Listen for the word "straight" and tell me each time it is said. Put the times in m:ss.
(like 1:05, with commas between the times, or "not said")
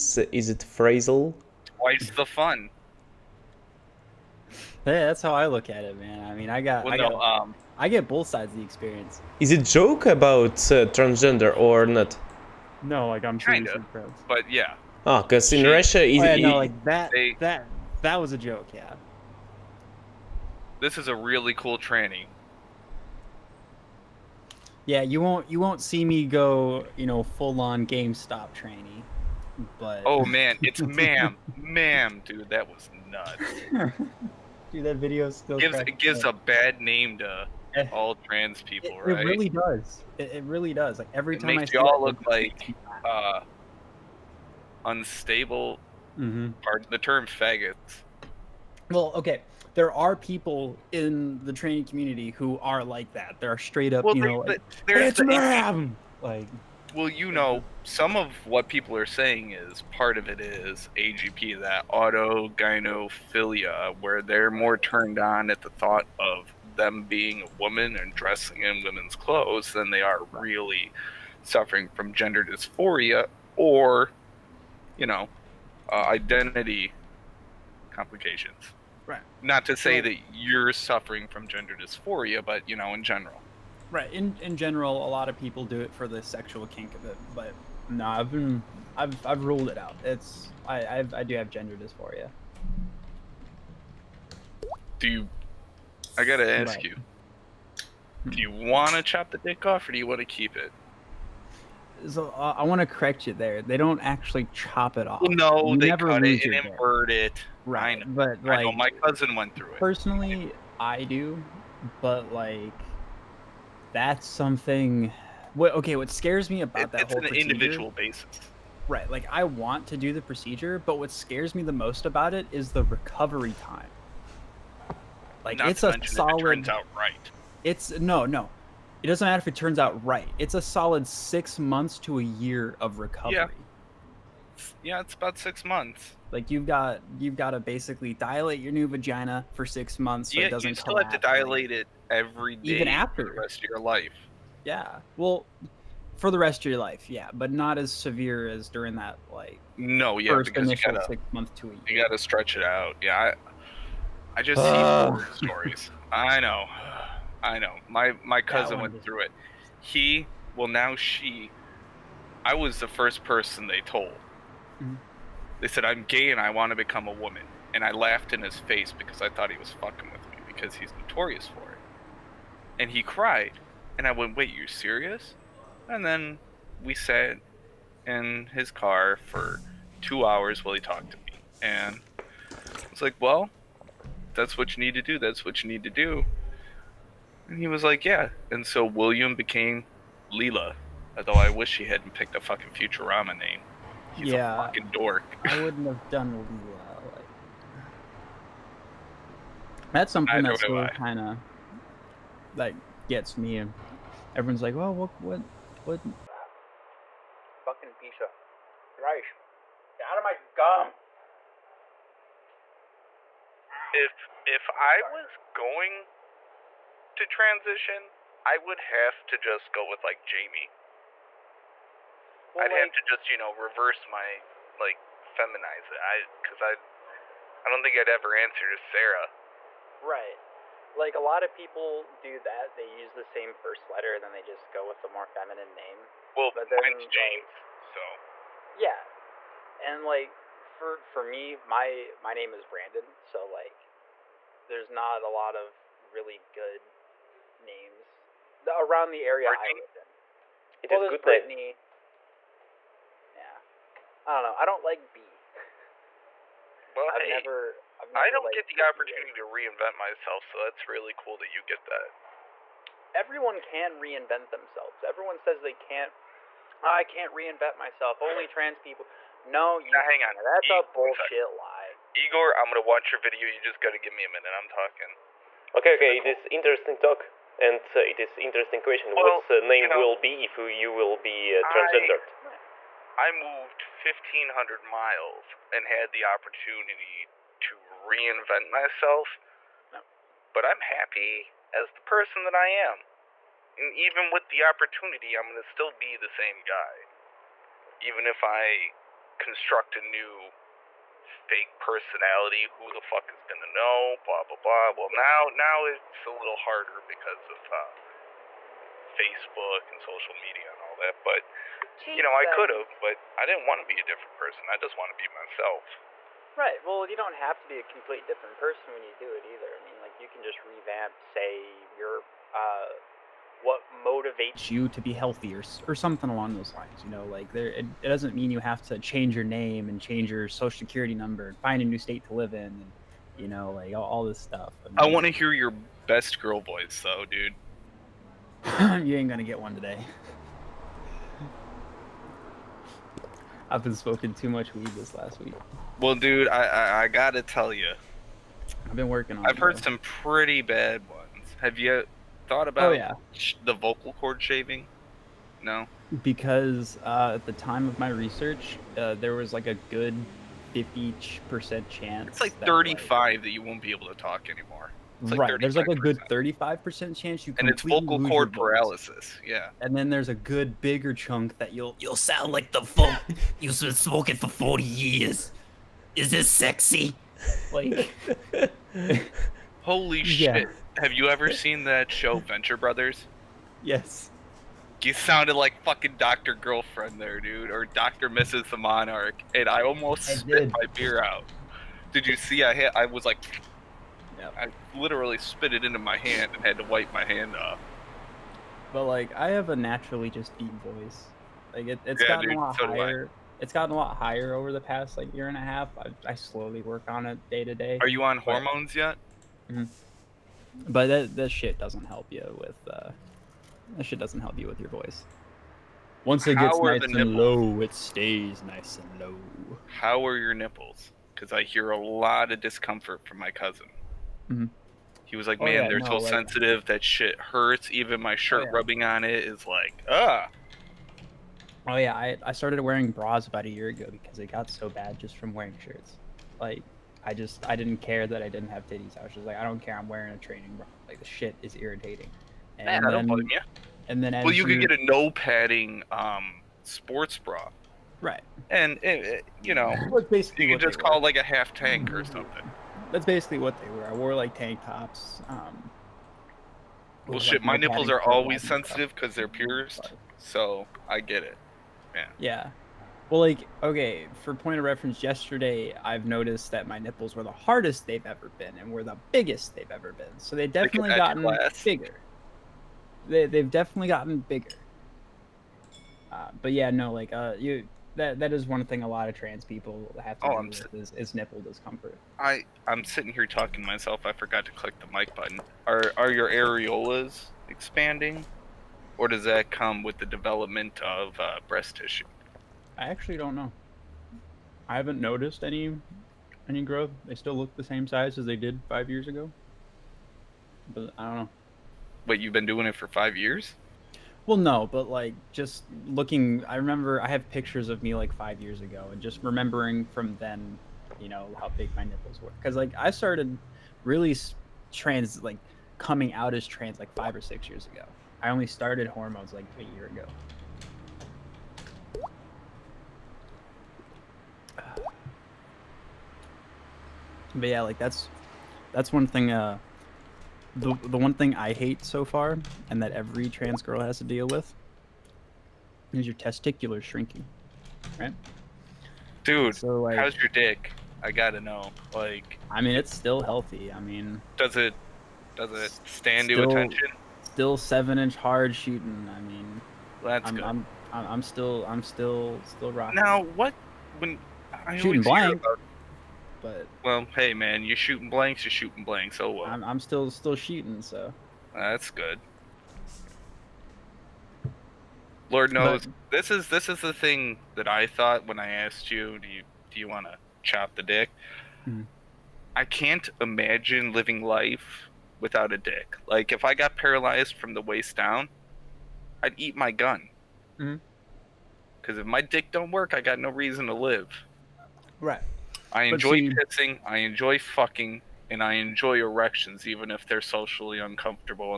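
0:53.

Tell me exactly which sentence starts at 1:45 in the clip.
no, you they never cut it and invert it.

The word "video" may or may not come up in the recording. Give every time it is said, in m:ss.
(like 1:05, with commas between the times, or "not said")
0:34, 4:33.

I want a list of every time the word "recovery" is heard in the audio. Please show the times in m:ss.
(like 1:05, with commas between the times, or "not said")
2:02, 2:12.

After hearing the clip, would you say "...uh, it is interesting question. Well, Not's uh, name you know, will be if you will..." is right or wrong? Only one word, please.
wrong.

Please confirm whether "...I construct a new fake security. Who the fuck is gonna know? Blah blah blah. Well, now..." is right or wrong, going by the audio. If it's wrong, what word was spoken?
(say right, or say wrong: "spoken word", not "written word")
wrong: "personality", not "security".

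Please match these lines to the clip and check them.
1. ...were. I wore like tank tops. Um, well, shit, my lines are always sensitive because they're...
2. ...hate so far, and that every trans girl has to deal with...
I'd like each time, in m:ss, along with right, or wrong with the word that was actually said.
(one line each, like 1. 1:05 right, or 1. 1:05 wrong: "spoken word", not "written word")
1. 7:33 wrong: "nipples", not "lines"
2. 8:51 right.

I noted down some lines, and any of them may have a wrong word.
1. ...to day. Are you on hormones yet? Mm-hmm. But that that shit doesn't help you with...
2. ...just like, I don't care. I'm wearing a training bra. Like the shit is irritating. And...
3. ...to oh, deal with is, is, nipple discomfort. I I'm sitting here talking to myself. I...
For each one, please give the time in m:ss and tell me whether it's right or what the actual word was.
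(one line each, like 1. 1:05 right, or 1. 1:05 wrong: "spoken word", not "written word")
1. 6:47 right
2. 7:19 right
3. 8:00 right.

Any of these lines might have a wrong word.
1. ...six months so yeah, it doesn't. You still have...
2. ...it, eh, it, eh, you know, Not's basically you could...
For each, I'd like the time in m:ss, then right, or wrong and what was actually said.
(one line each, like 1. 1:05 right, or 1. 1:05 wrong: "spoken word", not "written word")
1. 2:19 right
2. 7:29 wrong: "That", not "Not".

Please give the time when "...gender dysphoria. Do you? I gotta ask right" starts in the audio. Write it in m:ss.
1:31.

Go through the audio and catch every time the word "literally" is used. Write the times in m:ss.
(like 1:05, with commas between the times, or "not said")
6:34.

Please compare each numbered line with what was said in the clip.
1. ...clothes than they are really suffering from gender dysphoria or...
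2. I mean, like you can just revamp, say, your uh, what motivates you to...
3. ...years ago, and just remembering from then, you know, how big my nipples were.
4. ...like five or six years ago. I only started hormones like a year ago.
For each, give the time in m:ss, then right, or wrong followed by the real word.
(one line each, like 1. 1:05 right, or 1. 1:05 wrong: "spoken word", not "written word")
1. 1:09 right
2. 5:19 right
3. 8:28 right
4. 8:36 right.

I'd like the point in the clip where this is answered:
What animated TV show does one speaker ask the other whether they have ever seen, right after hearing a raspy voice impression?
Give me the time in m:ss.
6:22.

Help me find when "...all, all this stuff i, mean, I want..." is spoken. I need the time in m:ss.
5:33.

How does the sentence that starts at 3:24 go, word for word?
Everyone's like, "Well, what, what, what, fucking pizza, rice?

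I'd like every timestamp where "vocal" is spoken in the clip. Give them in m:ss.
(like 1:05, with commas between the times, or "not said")
5:53, 6:07.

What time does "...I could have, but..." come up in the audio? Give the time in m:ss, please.
5:12.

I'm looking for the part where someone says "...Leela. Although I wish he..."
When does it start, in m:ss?
3:10.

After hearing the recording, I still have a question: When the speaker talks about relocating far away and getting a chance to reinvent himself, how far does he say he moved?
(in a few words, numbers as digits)
1,500 miles.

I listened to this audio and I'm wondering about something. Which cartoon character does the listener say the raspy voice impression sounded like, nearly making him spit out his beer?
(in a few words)
Dr. Girlfriend.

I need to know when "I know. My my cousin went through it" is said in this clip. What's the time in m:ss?
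2:37.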